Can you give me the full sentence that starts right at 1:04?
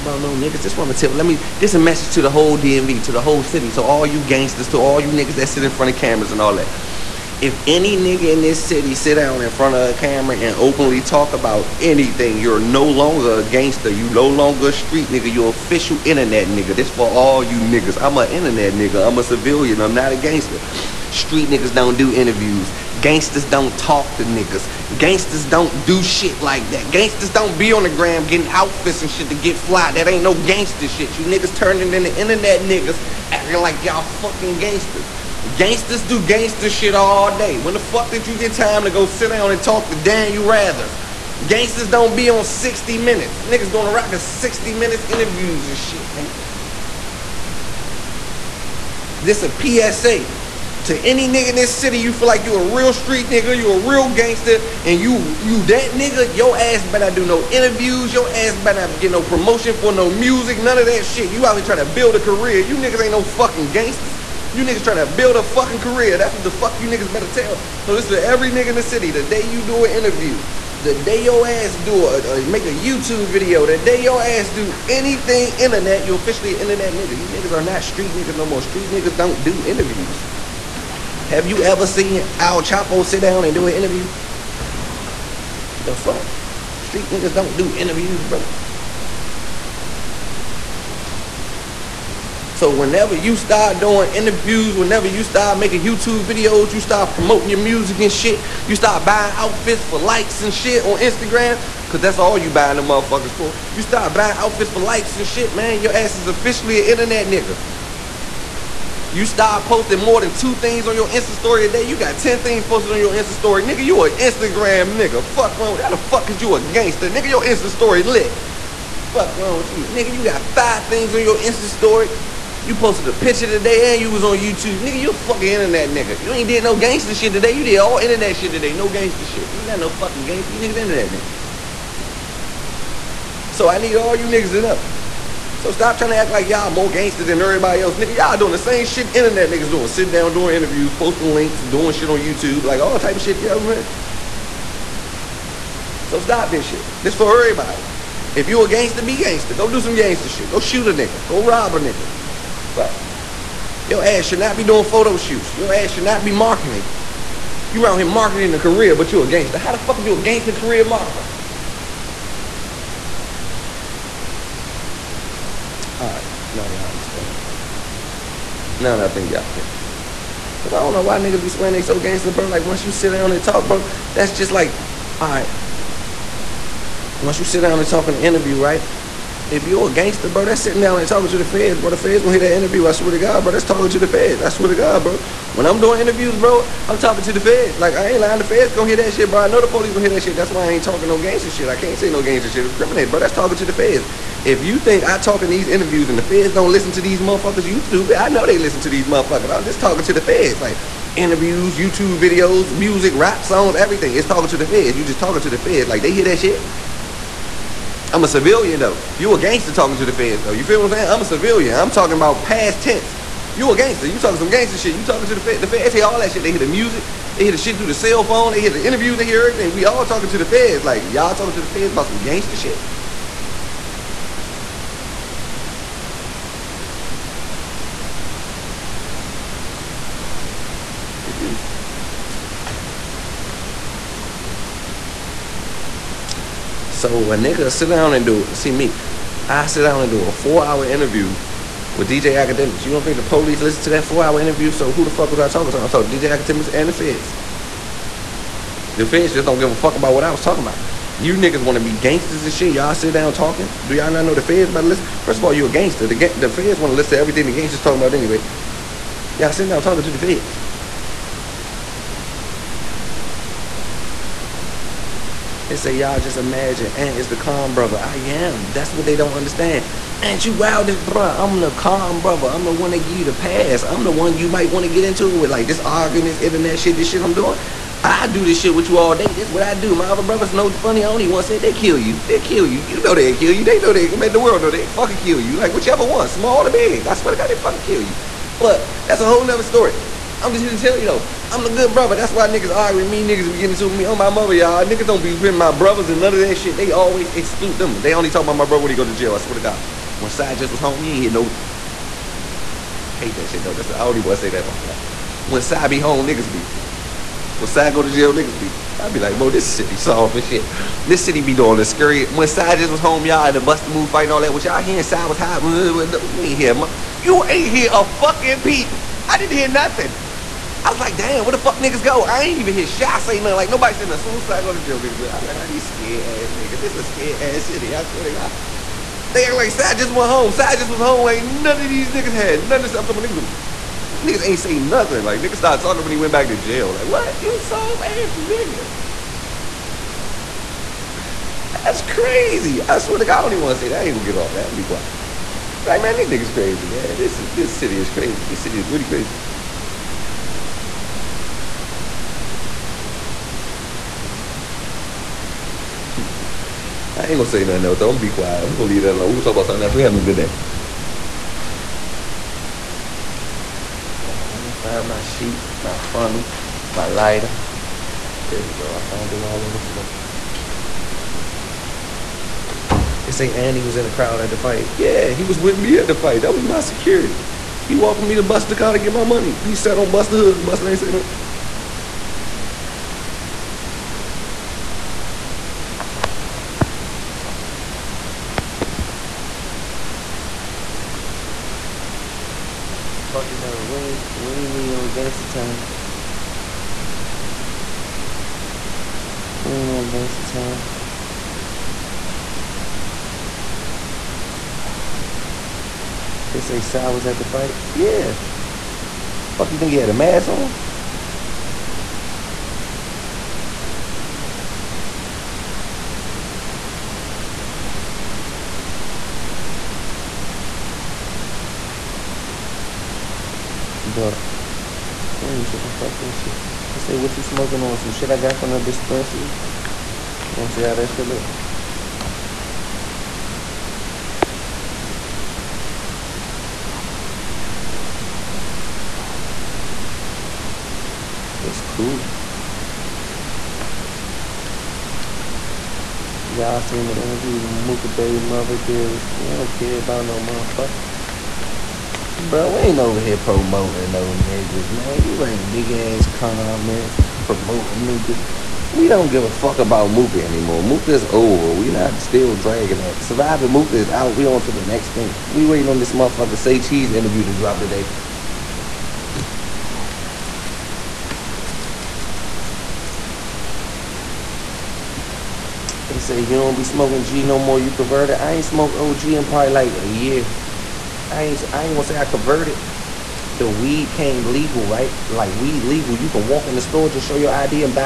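You niggas trying to build a fucking career.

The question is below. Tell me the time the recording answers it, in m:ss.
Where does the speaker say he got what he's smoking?
7:08.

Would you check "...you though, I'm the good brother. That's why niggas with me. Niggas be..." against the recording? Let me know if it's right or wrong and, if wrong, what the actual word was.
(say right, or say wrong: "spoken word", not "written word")
right.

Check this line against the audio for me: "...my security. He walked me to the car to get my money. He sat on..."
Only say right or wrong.
right.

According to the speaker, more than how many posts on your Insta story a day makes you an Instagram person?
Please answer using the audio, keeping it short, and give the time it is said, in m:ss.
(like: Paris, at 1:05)
2, at 1:50.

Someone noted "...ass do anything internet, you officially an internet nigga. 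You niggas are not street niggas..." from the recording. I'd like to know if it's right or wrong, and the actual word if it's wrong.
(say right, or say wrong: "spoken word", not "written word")
right.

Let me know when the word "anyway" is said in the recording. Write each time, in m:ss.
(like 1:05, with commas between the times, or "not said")
4:18.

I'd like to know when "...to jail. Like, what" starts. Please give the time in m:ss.
5:36.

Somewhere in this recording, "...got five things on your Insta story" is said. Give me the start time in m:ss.
2:00.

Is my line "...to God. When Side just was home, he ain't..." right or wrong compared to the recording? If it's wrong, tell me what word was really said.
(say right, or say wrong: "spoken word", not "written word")
right.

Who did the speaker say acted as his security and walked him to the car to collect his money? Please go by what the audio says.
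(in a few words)
Andy.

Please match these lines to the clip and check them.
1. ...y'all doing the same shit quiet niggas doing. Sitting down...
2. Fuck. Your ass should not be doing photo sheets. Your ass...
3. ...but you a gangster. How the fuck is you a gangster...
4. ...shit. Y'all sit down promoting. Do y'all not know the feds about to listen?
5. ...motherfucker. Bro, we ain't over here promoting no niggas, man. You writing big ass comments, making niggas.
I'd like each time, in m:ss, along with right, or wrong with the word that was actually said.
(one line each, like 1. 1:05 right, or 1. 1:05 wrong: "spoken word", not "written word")
1. 2:18 wrong: "internet", not "quiet"
2. 2:32 wrong: "shoots", not "sheets"
3. 2:38 right
4. 4:12 wrong: "talking", not "promoting"
5. 7:30 wrong: "promoting", not "making".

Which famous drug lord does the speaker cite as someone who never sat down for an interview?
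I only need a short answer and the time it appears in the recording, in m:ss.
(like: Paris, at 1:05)
El Chapo, at 1:22.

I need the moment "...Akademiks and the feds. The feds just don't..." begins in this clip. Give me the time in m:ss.
4:06.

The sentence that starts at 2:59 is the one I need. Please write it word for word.
If you're a gangster, bro, that's sitting down and talking to the feds, bro.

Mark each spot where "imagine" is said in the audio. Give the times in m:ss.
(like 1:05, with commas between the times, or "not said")
4:26.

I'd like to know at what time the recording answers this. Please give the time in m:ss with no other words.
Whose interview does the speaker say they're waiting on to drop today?
7:46.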